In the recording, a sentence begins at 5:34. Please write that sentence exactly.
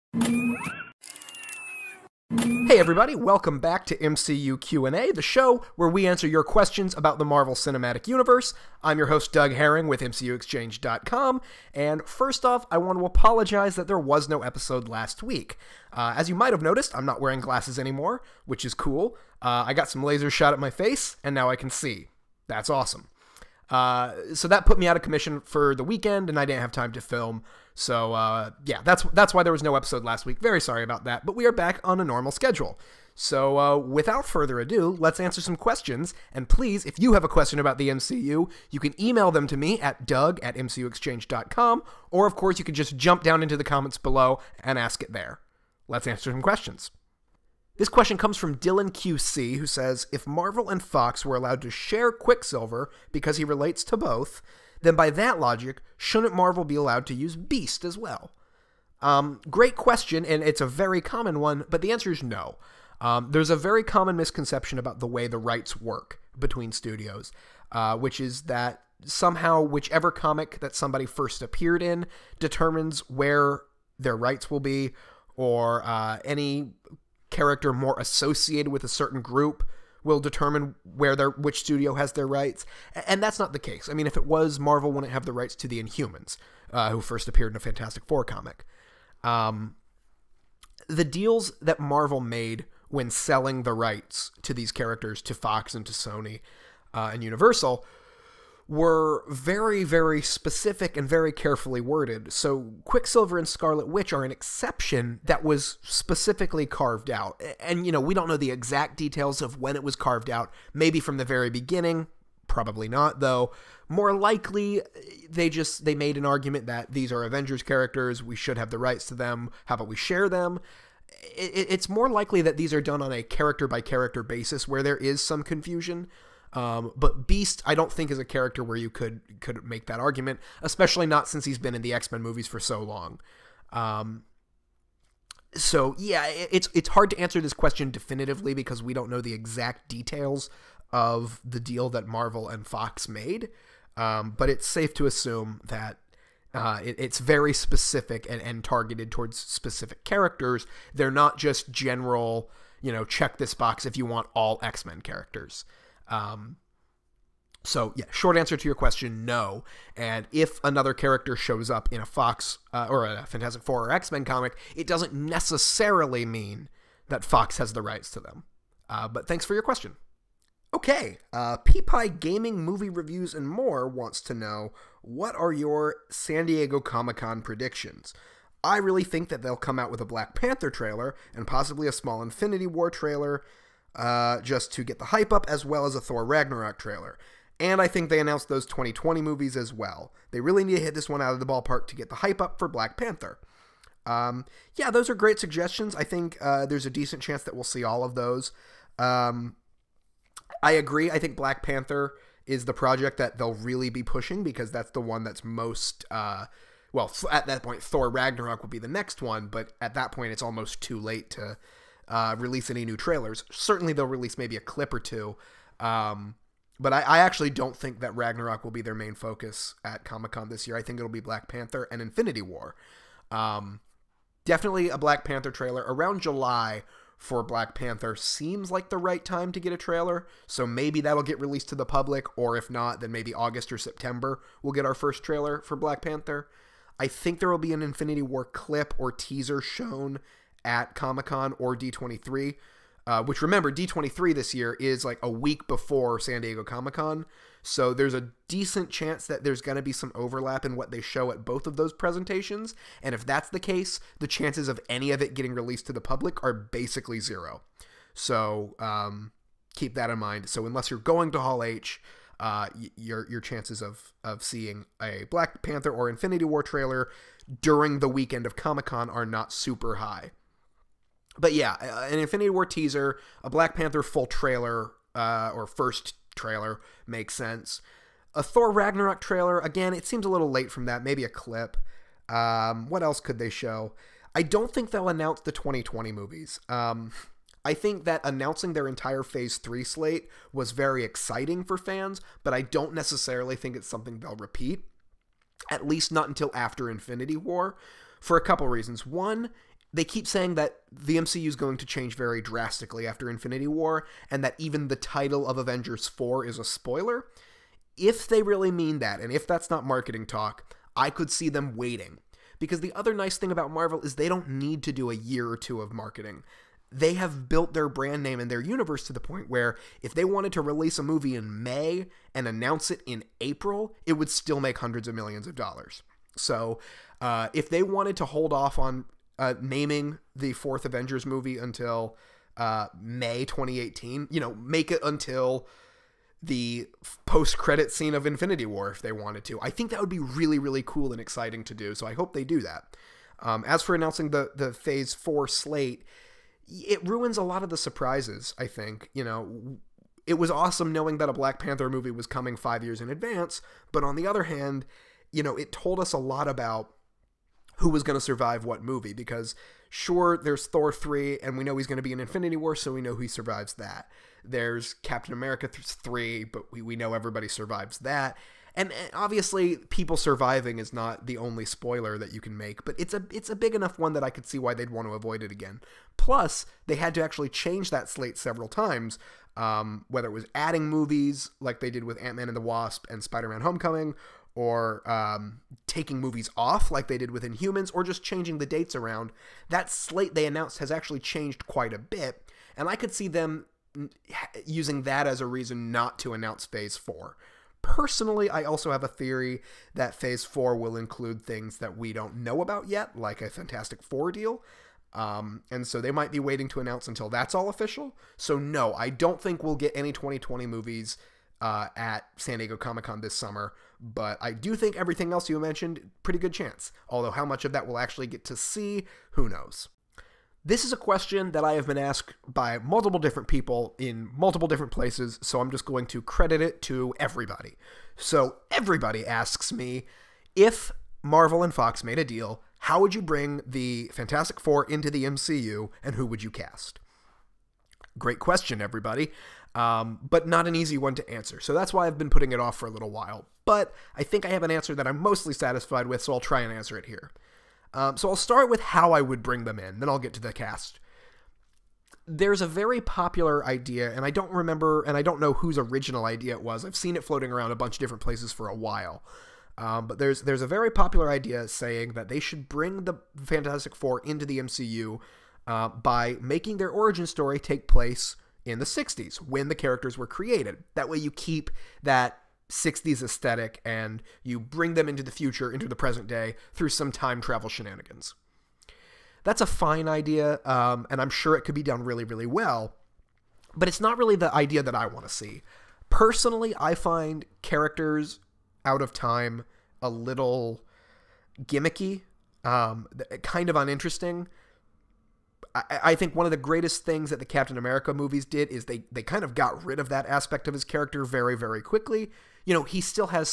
You know, make it until the post credit scene of Infinity War if they wanted to.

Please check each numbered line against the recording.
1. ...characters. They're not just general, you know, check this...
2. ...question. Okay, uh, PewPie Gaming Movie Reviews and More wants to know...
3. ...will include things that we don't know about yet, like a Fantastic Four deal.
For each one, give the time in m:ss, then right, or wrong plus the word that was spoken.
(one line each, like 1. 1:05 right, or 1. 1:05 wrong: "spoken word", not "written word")
1. 2:30 right
2. 2:49 right
3. 6:40 right.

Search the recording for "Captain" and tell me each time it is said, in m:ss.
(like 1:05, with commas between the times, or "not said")
6:04, 8:17.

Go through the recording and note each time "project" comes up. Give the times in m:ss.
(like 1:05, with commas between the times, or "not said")
3:22.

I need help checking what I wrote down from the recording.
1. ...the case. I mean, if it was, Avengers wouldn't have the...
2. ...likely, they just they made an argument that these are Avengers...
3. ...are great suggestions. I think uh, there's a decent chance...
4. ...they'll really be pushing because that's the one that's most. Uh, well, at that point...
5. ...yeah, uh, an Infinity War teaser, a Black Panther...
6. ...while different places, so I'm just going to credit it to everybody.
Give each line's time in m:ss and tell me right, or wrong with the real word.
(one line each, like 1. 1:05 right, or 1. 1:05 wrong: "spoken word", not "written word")
1. 1:23 wrong: "Marvel", not "Avengers"
2. 1:54 right
3. 3:15 right
4. 3:23 right
5. 4:31 right
6. 7:04 wrong: "multiple", not "while".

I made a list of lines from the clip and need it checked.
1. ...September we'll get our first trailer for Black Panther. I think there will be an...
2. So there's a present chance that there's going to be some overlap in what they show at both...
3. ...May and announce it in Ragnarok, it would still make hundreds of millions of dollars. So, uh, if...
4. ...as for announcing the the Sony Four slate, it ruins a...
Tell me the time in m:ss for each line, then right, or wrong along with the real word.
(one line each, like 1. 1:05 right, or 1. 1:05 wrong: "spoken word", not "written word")
1. 3:53 right
2. 4:07 wrong: "decent", not "present"
3. 5:21 wrong: "April", not "Ragnarok"
4. 5:43 wrong: "Phase", not "Sony".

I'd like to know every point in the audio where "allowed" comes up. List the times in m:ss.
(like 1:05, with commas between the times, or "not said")
0:51, 0:56.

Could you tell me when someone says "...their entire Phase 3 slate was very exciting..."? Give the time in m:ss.
4:48.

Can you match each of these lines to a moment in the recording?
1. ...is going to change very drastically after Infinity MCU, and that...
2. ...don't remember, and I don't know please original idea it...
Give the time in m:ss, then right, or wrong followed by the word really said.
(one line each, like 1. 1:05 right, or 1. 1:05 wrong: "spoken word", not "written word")
1. 5:01 wrong: "War", not "MCU"
2. 7:34 wrong: "whose", not "please".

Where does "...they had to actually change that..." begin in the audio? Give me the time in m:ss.
6:16.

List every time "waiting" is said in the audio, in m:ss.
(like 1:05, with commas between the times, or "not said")
5:11, 6:46.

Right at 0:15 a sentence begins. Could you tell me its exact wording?
Uh, as you might have noticed, I'm not wearing glasses anymore, which is cool.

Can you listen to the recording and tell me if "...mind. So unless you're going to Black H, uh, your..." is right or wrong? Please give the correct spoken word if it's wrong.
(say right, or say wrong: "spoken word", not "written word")
wrong: "Hall", not "Black".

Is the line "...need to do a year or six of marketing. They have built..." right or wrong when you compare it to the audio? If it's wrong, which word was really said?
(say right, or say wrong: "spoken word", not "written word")
wrong: "two", not "six".